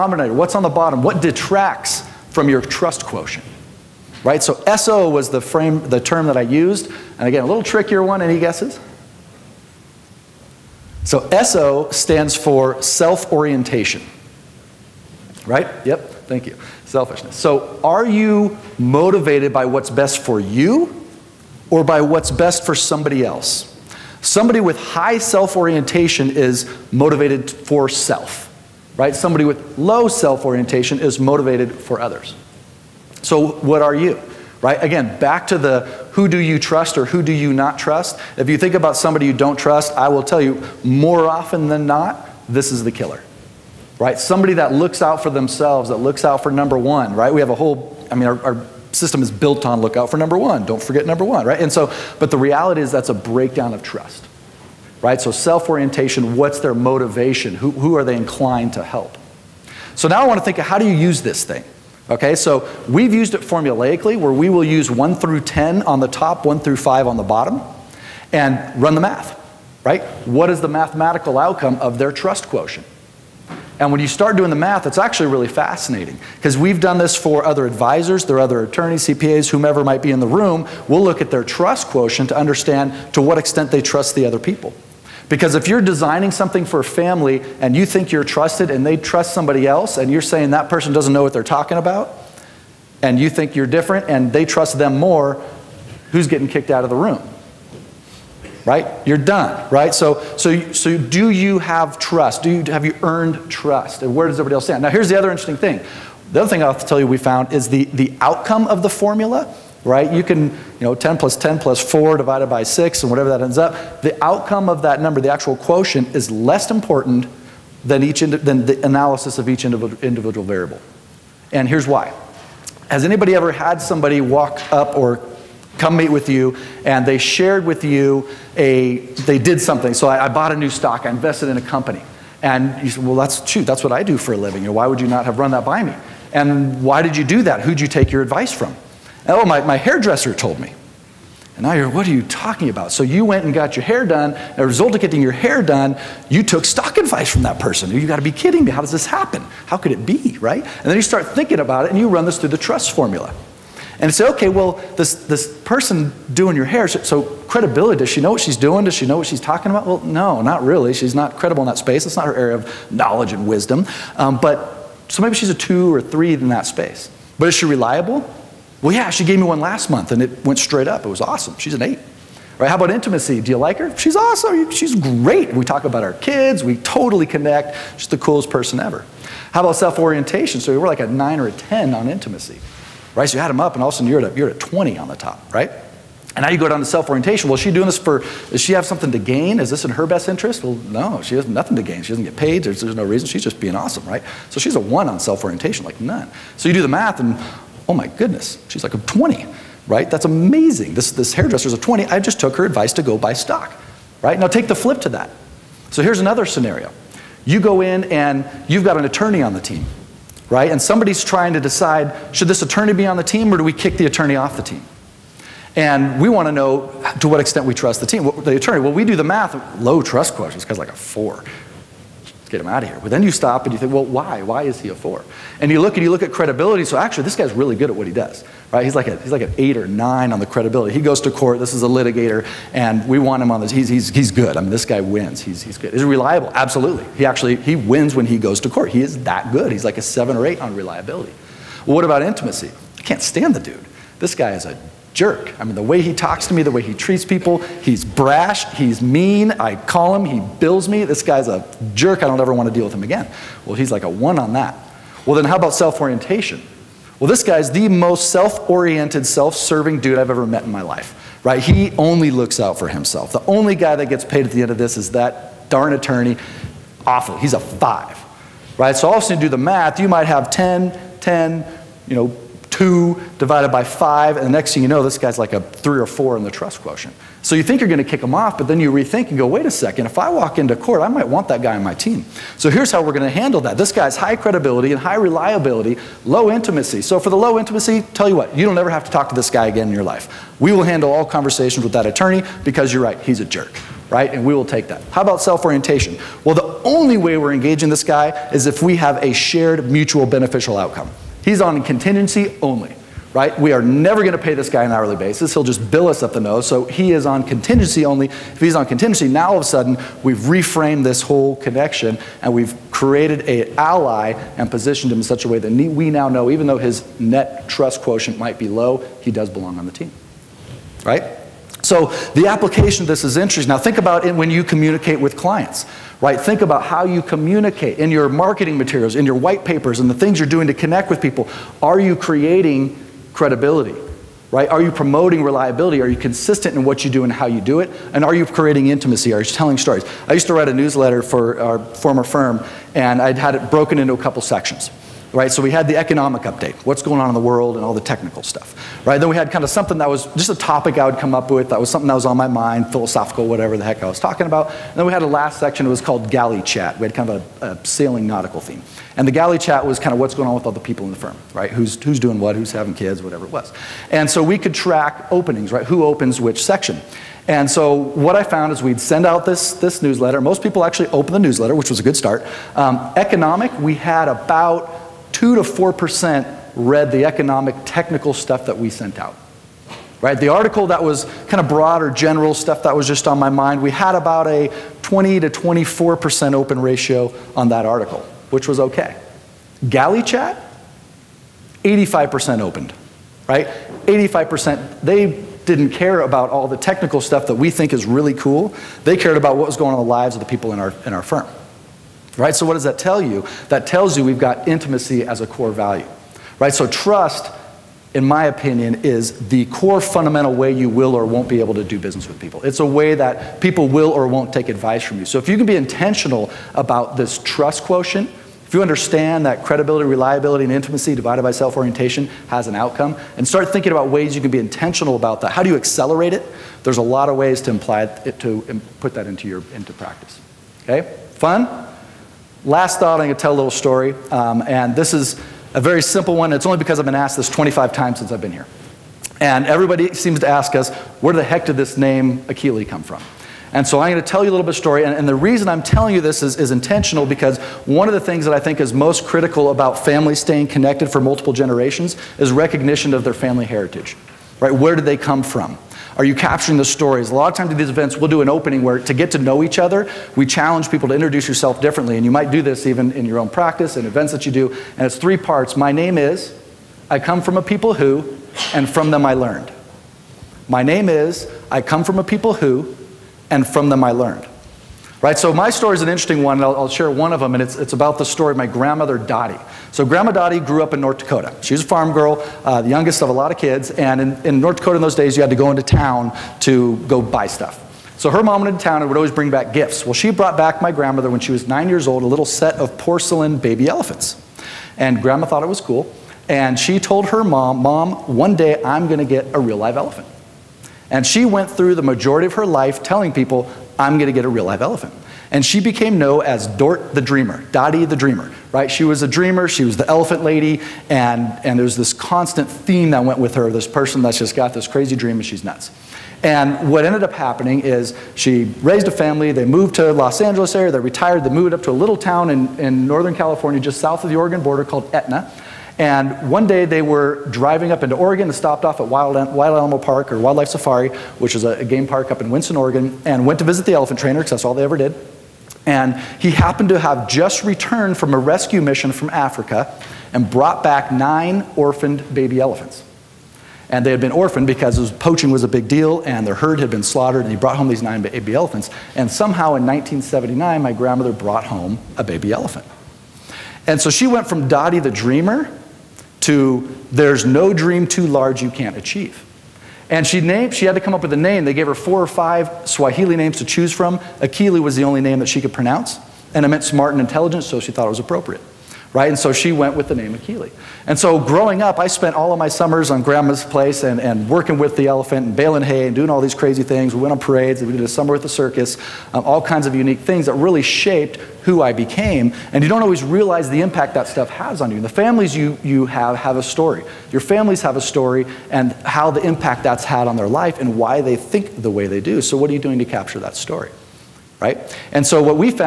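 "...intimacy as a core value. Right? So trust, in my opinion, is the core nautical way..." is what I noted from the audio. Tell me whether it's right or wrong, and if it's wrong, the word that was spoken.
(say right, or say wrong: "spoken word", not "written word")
wrong: "fundamental", not "nautical".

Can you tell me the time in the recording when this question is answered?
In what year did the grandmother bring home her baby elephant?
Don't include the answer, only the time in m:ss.
9:09.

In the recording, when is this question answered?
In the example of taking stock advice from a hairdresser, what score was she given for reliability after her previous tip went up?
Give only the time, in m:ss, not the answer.
2:51.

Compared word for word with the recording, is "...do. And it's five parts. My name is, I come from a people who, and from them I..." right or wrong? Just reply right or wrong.
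wrong.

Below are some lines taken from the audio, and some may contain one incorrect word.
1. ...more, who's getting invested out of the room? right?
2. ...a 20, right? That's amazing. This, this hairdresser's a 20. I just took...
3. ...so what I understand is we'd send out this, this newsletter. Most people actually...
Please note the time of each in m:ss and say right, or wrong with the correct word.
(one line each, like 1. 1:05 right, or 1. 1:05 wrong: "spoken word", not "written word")
1. 1:34 wrong: "kicked", not "invested"
2. 3:18 right
3. 6:07 wrong: "found", not "understand".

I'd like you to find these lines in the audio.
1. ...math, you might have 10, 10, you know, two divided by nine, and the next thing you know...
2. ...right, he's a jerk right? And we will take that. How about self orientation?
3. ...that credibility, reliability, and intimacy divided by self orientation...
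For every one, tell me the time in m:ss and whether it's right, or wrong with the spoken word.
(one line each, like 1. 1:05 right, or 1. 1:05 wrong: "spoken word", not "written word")
1. 4:29 wrong: "five", not "nine"
2. 4:53 right
3. 6:59 right.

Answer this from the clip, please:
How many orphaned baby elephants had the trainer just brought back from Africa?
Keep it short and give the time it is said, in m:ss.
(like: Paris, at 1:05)
9, at 9:01.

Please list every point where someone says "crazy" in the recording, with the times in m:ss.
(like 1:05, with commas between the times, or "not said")
8:34, 9:36.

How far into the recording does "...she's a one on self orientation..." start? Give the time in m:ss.
3:14.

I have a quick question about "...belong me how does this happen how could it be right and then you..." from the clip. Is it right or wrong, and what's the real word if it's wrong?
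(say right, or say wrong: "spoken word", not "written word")
wrong: "kidding", not "belong".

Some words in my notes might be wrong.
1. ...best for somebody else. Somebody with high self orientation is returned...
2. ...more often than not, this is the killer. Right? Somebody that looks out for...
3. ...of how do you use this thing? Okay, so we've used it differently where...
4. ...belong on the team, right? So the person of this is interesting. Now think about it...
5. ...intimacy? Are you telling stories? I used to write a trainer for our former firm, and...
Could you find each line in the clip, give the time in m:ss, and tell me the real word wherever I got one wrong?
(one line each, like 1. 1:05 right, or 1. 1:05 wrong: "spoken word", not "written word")
1. 0:22 wrong: "motivated", not "returned"
2. 0:40 right
3. 1:00 wrong: "formulaically", not "differently"
4. 5:19 wrong: "application", not "person"
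5. 5:38 wrong: "newsletter", not "trainer".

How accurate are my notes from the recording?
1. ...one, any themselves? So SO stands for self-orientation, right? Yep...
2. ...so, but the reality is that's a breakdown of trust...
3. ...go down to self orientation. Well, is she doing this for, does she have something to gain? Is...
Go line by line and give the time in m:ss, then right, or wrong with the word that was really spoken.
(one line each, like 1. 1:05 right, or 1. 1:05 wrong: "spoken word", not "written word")
1. 0:08 wrong: "guesses", not "themselves"
2. 0:51 right
3. 3:06 right.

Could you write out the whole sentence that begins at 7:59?
So Grandma Dottie grew up in North Dakota.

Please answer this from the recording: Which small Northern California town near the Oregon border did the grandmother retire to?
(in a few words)
Etna.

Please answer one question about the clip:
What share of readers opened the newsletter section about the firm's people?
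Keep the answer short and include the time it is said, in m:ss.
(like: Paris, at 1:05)
85%, at 6:31.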